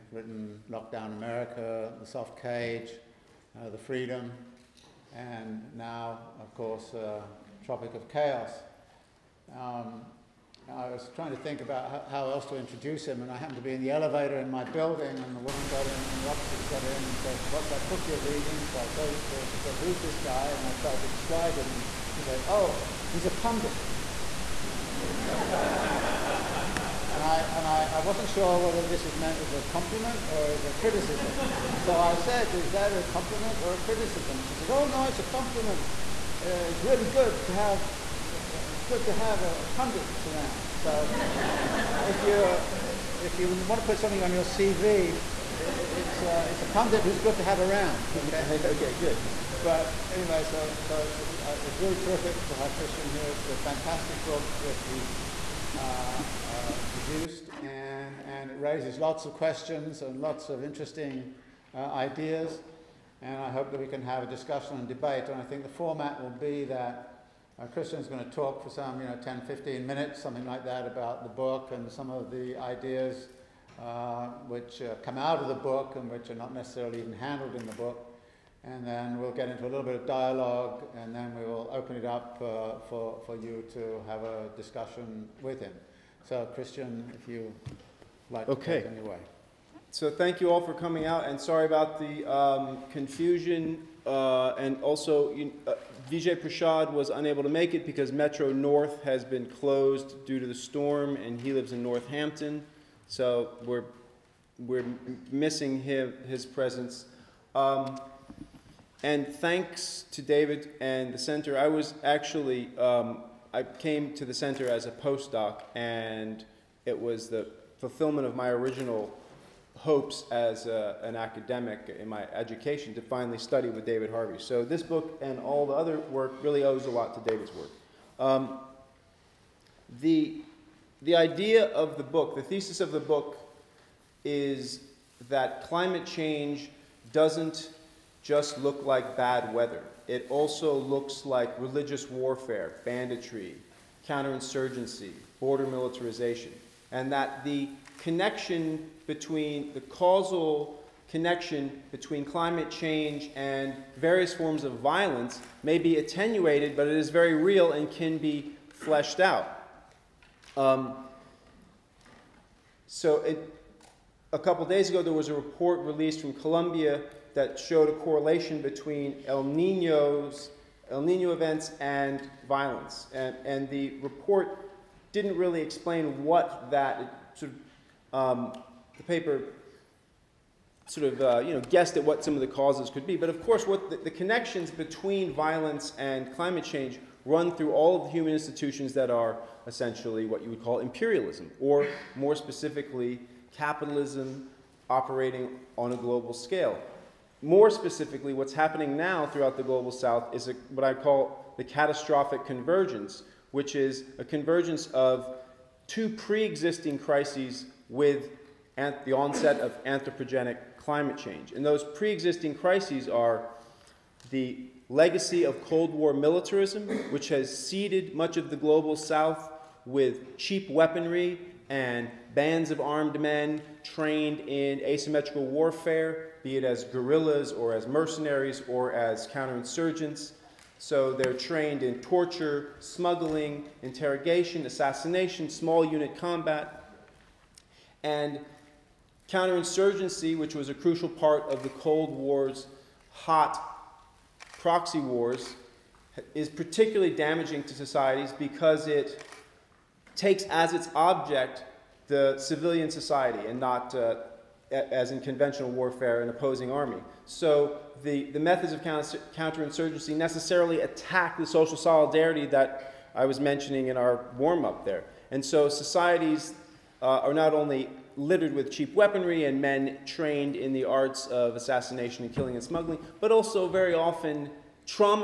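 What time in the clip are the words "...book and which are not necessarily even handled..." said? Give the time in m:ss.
1:15.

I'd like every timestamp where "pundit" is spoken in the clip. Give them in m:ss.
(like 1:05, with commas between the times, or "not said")
0:23, 0:39, 0:46.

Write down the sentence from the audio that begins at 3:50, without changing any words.
So they're trained in torture, smuggling, interrogation, assassination, small unit combat.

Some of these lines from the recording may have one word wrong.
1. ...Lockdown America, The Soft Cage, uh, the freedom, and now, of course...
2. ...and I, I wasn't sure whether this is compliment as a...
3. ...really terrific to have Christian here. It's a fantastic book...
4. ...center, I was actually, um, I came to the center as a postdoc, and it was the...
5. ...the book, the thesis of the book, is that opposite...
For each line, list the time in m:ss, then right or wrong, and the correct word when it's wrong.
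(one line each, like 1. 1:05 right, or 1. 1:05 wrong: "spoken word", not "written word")
1. 0:00 right
2. 0:27 wrong: "meant", not "compliment"
3. 0:51 right
4. 1:51 right
5. 2:11 wrong: "climate", not "opposite".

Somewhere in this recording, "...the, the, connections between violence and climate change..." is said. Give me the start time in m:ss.
3:03.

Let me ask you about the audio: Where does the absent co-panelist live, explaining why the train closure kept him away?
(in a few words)
Northampton.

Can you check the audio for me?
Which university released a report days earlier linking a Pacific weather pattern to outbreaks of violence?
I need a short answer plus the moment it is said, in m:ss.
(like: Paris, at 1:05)
Columbia, at 2:46.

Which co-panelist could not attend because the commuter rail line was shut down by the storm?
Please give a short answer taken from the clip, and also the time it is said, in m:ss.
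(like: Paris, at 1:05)
Vijay Prashad, at 1:36.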